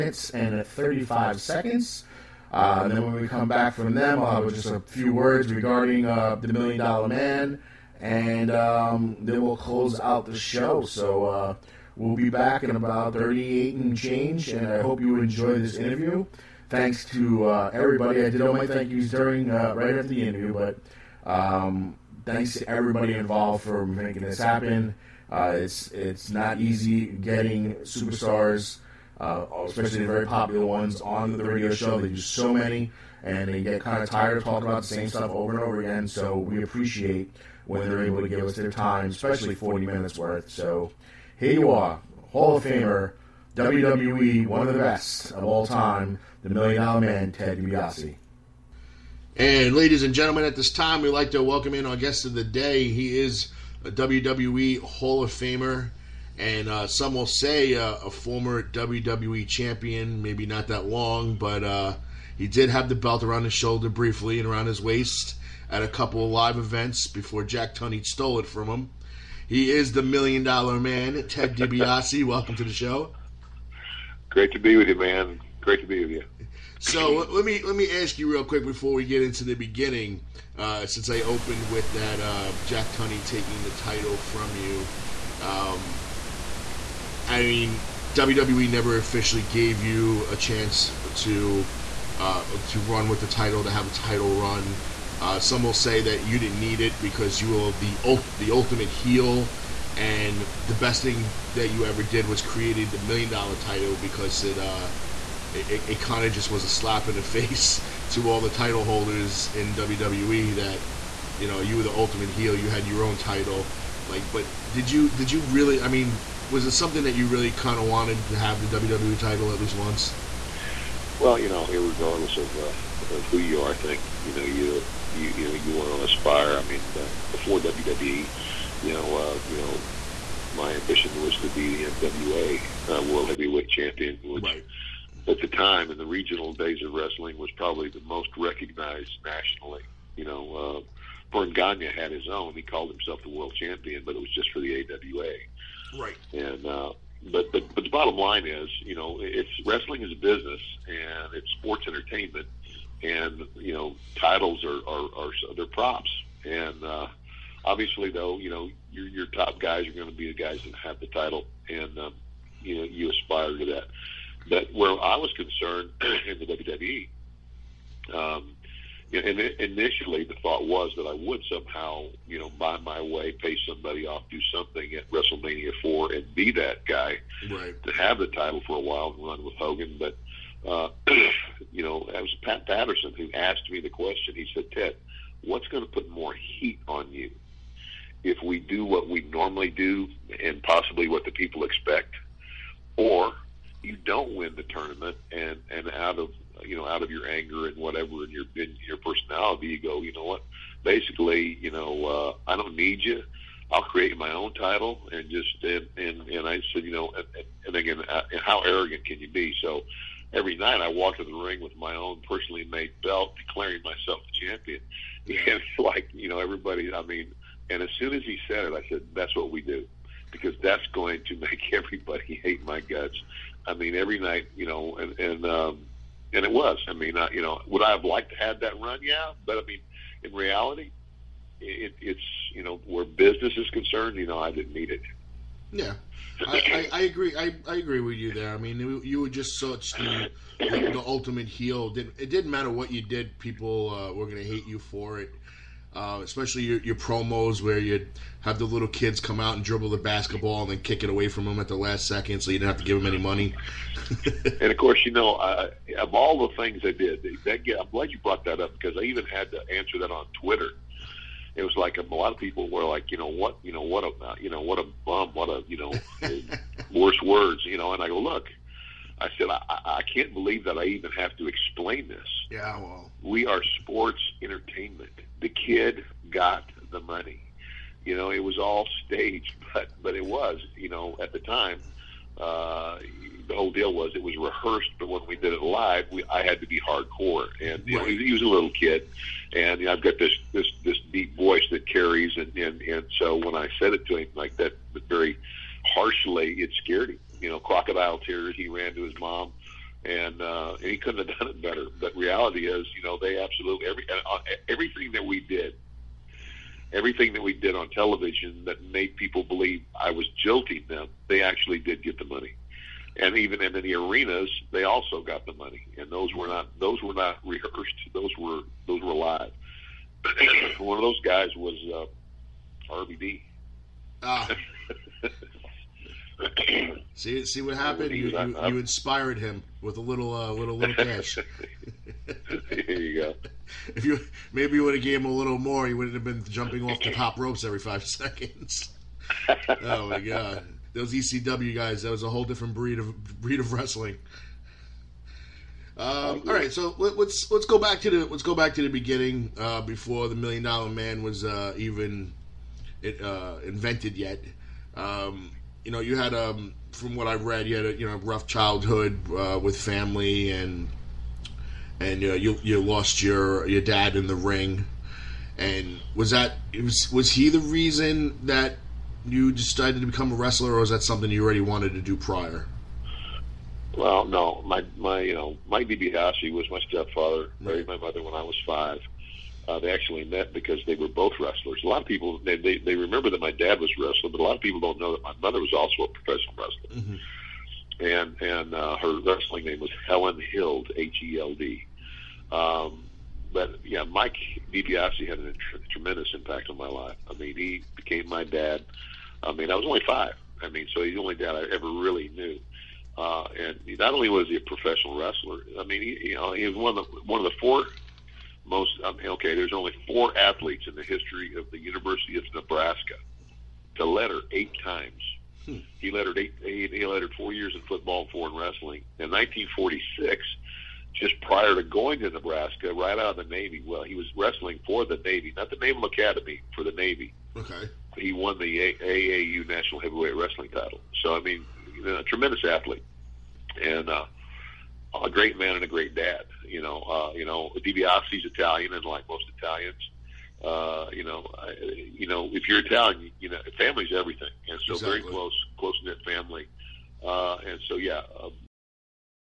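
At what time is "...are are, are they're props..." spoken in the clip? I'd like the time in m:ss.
2:34.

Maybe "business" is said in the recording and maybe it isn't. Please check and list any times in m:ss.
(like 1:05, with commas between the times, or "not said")
2:30, 3:53.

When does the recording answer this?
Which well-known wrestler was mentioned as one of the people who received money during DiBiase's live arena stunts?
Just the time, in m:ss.
5:22.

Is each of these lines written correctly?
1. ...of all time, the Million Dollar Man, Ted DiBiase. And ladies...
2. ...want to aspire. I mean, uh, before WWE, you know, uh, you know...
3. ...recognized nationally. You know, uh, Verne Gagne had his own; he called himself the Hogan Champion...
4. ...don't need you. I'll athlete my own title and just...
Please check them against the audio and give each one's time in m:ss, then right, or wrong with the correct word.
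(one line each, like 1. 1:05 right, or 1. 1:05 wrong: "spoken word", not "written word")
1. 0:45 right
2. 2:05 right
3. 2:18 wrong: "World", not "Hogan"
4. 3:22 wrong: "create", not "athlete".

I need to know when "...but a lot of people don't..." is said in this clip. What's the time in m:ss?
6:24.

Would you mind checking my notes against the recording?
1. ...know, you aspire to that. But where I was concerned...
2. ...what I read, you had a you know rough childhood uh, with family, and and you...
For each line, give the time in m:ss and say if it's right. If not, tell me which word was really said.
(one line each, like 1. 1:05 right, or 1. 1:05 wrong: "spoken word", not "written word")
1. 2:42 right
2. 5:57 right.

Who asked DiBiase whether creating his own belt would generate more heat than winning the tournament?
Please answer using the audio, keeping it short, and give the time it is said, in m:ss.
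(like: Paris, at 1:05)
Pat Patterson, at 3:02.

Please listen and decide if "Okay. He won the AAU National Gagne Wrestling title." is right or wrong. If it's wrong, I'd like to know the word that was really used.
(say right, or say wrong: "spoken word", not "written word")
wrong: "Heavyweight", not "Gagne".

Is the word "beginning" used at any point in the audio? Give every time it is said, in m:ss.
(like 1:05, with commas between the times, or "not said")
1:19, 5:48.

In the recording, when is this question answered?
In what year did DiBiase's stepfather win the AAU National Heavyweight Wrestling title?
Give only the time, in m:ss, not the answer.
6:59.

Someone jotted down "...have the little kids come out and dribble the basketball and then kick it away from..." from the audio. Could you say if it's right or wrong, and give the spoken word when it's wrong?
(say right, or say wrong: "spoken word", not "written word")
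right.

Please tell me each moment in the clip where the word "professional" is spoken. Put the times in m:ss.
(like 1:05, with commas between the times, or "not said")
6:26, 6:44.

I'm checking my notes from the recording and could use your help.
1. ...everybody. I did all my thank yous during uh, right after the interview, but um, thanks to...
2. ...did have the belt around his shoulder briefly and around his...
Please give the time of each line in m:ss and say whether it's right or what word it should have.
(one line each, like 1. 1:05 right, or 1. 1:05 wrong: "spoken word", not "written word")
1. 0:17 right
2. 1:02 right.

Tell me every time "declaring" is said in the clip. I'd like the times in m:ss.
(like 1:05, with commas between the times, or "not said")
3:33.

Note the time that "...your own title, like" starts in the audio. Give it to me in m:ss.
1:52.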